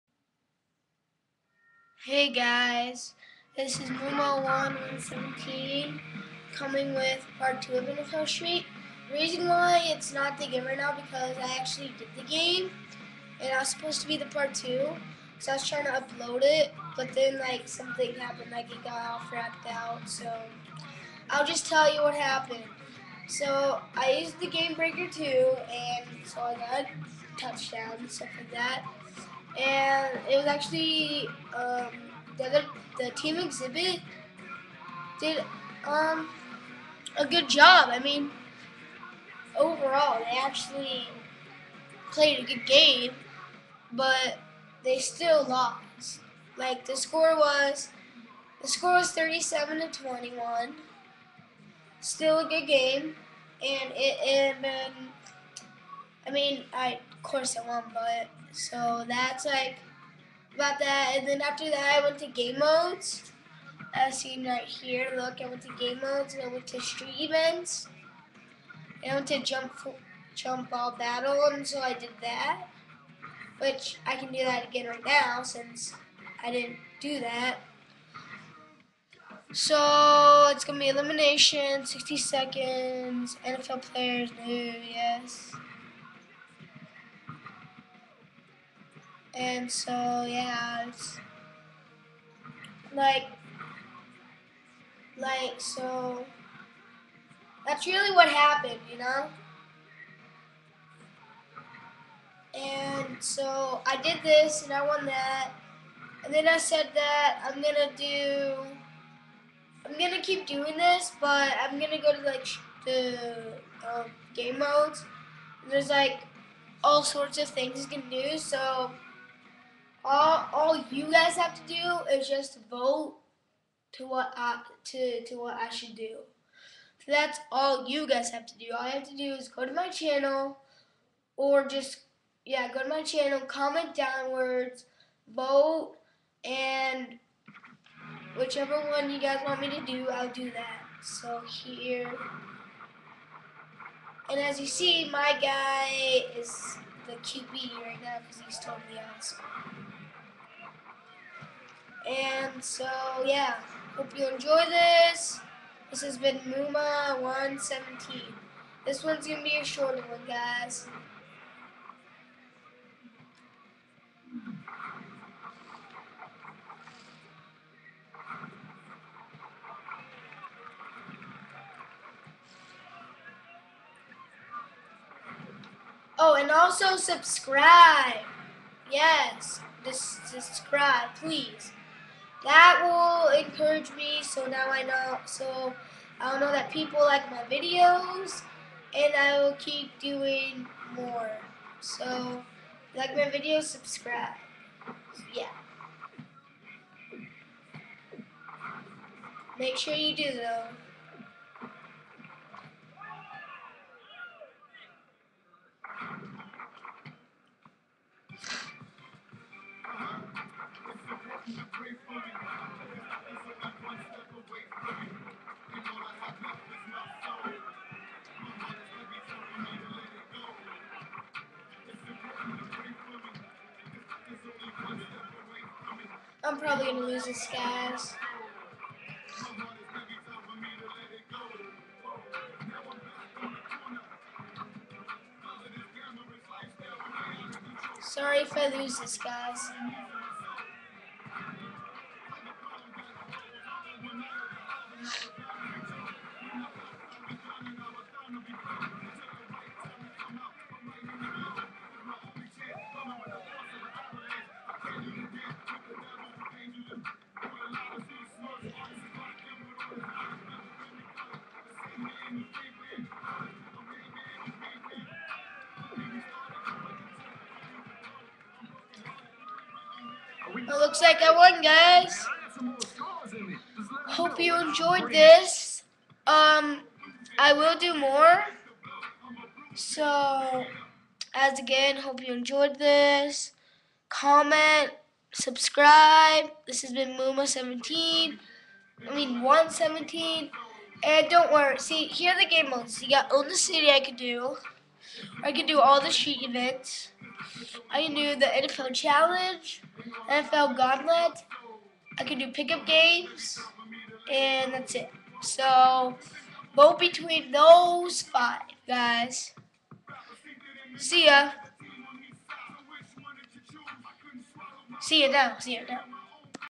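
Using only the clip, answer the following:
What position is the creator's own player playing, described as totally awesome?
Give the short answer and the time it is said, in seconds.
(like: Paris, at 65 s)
QB, at 147 s.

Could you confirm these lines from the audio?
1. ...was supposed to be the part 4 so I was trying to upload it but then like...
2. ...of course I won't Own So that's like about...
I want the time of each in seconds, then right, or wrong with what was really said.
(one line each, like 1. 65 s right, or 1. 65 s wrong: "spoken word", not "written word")
1. 13 s wrong: "2", not "4"
2. 57 s wrong: "But", not "Own".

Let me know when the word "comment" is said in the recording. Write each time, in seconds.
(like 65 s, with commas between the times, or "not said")
133 s, 284 s.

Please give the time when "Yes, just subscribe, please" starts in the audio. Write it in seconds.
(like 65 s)
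178 s.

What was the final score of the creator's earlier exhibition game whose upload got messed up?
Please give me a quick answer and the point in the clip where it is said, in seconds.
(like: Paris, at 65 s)
37 to 21, at 49 s.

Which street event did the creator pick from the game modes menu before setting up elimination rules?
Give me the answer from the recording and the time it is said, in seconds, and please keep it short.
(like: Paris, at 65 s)
jump ball battle, at 70 s.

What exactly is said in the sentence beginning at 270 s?
It looks like I won, guys.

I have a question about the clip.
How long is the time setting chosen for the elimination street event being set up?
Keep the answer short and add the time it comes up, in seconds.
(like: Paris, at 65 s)
60 seconds, at 81 s.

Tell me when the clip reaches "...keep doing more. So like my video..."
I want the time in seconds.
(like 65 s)
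189 s.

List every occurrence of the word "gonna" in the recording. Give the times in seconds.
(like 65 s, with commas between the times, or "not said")
80 s, 226 s.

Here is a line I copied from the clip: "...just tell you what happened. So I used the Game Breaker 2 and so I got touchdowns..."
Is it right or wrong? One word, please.
right.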